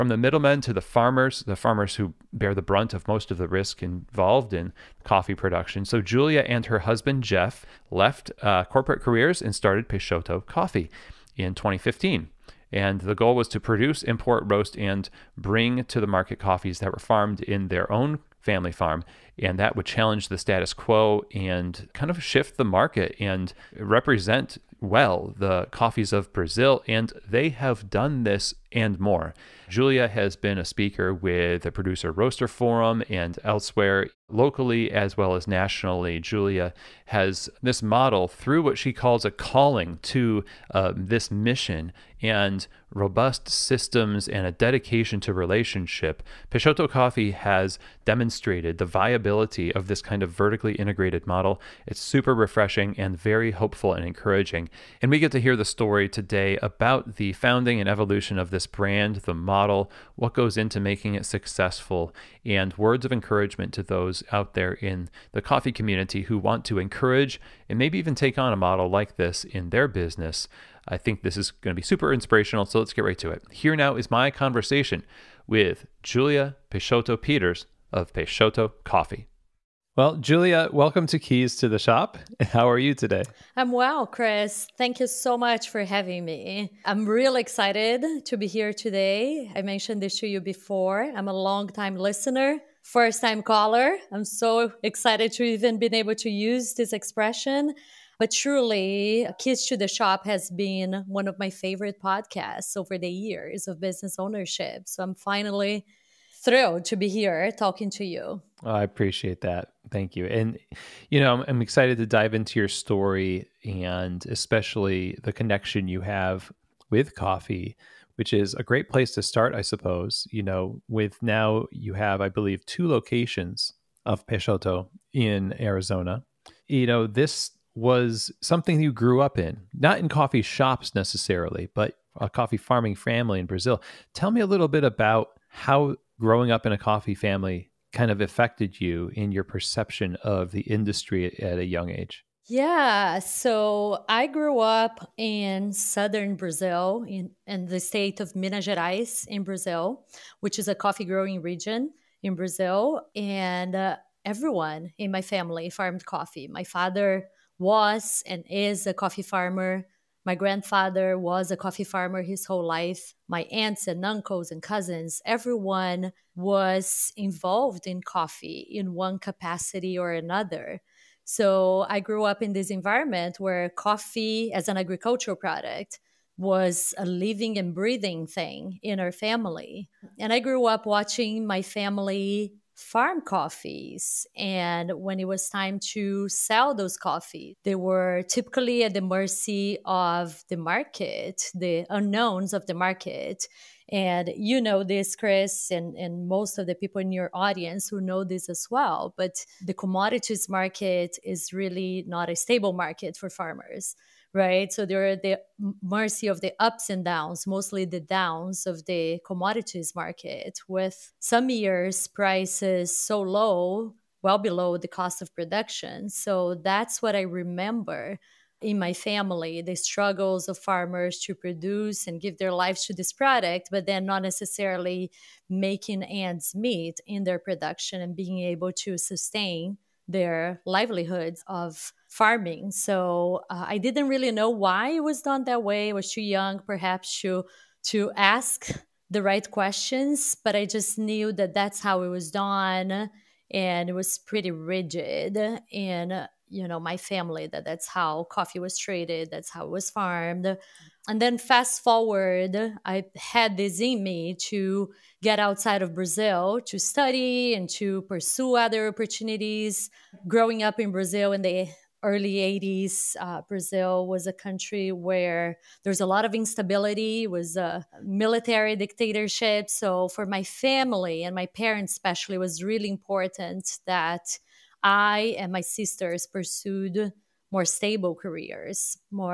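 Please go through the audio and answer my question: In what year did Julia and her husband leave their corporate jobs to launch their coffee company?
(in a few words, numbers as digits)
2015.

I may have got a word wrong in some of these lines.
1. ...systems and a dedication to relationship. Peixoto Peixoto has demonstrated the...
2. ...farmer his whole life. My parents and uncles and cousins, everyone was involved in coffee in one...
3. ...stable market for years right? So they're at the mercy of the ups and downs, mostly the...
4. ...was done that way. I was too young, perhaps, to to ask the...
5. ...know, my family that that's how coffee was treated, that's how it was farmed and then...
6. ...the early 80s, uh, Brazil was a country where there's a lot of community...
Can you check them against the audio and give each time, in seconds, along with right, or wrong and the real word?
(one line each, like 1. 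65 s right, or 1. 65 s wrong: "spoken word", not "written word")
1. 43 s wrong: "Coffee", not "Peixoto"
2. 161 s wrong: "aunts", not "parents"
3. 202 s wrong: "farmers", not "years"
4. 235 s right
5. 246 s right
6. 261 s wrong: "instability", not "community".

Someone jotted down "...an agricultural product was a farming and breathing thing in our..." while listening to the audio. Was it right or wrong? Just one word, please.
wrong.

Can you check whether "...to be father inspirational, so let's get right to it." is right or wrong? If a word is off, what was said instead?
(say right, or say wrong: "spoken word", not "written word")
wrong: "super", not "father".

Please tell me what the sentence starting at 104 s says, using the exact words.
So I'm finally thrilled to be here talking to you.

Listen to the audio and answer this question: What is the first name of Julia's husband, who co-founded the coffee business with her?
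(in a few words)
Jeff.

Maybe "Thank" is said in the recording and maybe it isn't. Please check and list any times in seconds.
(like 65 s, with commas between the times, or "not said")
84 s, 109 s.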